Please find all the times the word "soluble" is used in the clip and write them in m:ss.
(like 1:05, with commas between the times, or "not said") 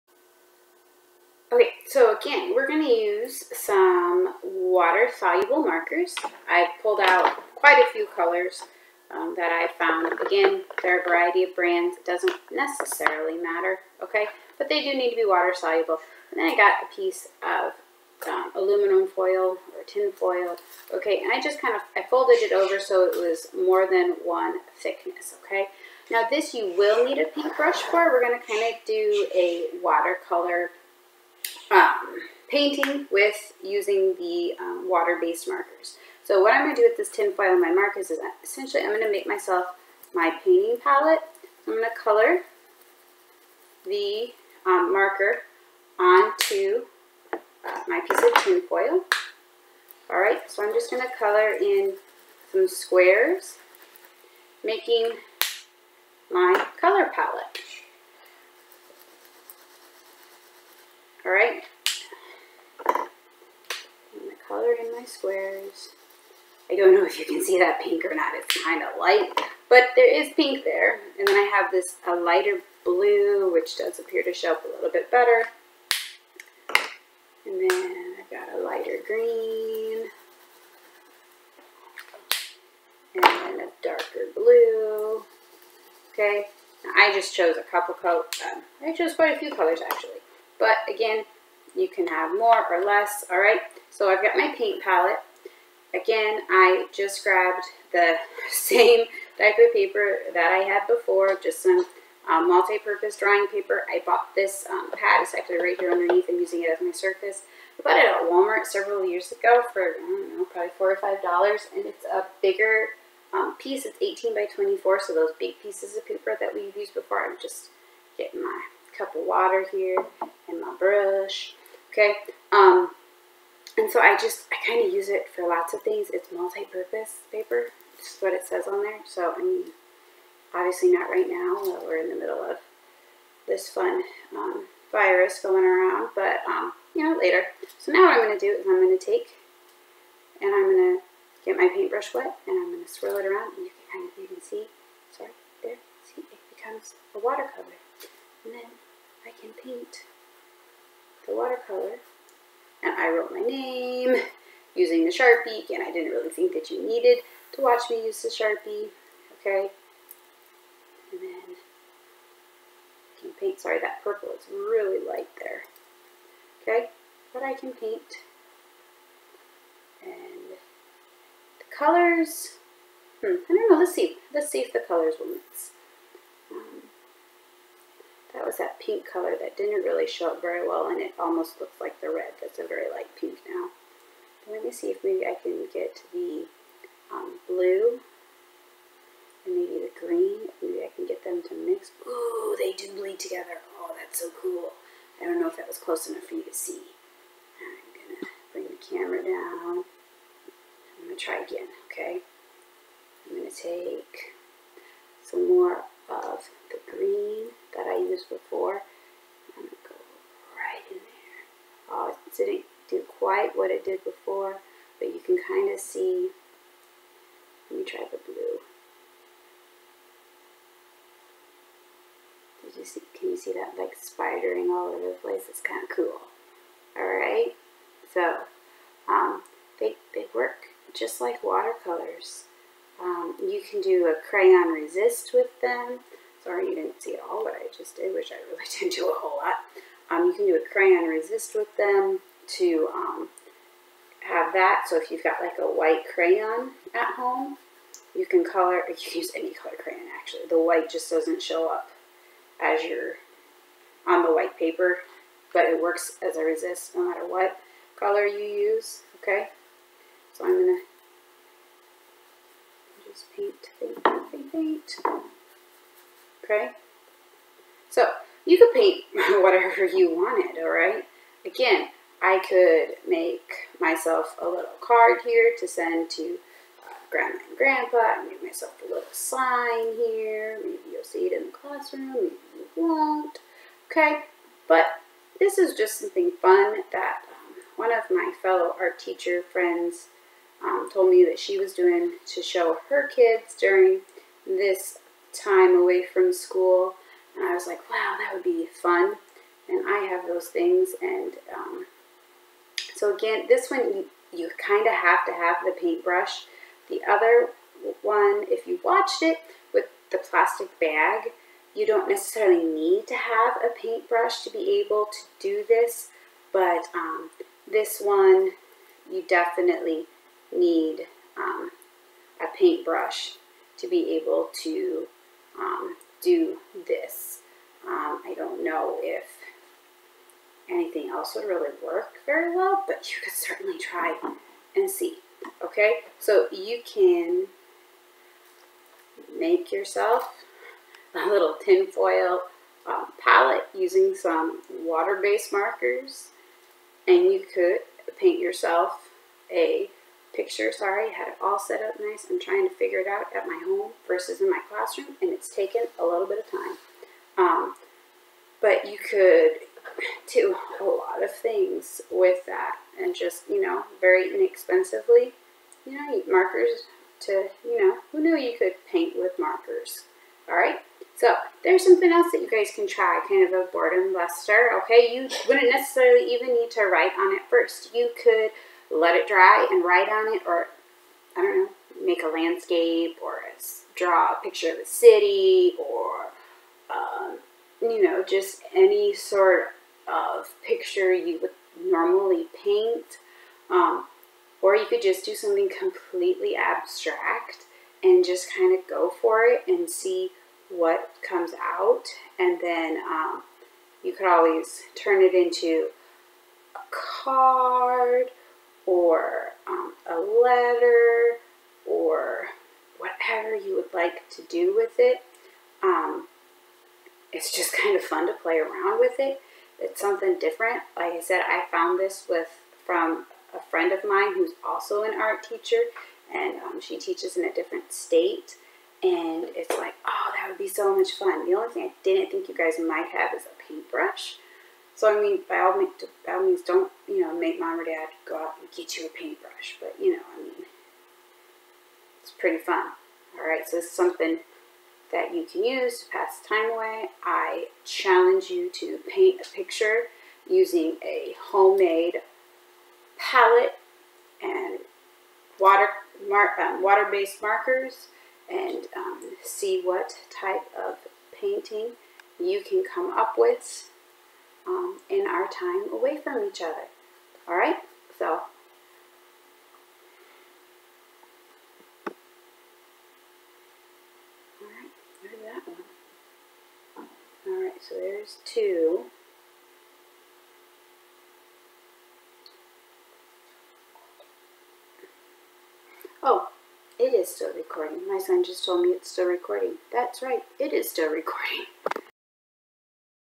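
0:04, 0:15.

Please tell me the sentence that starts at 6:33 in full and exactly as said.
Um, or you could just do something completely abstract and just kind of go for it and see what comes out.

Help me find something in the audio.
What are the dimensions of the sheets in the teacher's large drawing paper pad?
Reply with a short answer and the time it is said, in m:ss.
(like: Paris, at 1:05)
18 by 24, at 1:53.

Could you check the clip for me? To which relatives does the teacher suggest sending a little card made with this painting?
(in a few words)
Grandma and Grandpa.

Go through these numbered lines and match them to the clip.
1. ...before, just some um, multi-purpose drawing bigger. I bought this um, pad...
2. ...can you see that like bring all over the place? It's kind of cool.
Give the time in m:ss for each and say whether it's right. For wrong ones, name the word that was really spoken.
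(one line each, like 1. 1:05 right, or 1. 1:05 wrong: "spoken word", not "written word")
1. 1:40 wrong: "paper", not "bigger"
2. 3:43 wrong: "spidering", not "bring".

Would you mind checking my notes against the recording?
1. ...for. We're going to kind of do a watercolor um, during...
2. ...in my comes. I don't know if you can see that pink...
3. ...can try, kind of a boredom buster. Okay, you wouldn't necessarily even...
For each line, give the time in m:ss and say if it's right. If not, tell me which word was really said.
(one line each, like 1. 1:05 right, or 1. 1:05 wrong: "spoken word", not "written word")
1. 0:27 wrong: "painting", not "during"
2. 1:04 wrong: "squares", not "comes"
3. 6:12 right.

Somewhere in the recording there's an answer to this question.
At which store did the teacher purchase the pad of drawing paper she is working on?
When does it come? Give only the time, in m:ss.
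1:48.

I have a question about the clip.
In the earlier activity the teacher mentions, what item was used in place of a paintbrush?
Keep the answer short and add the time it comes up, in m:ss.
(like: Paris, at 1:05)
plastic bag, at 5:10.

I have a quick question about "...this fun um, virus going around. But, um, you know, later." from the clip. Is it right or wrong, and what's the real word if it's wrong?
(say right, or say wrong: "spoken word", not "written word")
right.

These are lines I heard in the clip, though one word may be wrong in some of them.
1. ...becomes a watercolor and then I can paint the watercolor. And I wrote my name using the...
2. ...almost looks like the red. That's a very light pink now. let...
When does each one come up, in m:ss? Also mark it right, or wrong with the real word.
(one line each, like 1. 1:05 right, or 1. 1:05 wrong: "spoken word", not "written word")
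1. 2:26 right
2. 3:01 right.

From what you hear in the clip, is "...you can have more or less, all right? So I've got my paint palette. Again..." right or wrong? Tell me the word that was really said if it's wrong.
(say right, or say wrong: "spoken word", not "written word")
right.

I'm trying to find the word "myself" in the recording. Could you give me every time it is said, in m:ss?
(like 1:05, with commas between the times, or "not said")
0:39, 4:33, 4:38.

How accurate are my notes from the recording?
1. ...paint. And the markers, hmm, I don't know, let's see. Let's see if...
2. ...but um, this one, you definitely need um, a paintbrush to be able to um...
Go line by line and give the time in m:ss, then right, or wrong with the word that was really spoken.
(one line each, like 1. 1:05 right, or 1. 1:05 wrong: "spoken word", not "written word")
1. 2:47 wrong: "colors", not "markers"
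2. 5:16 right.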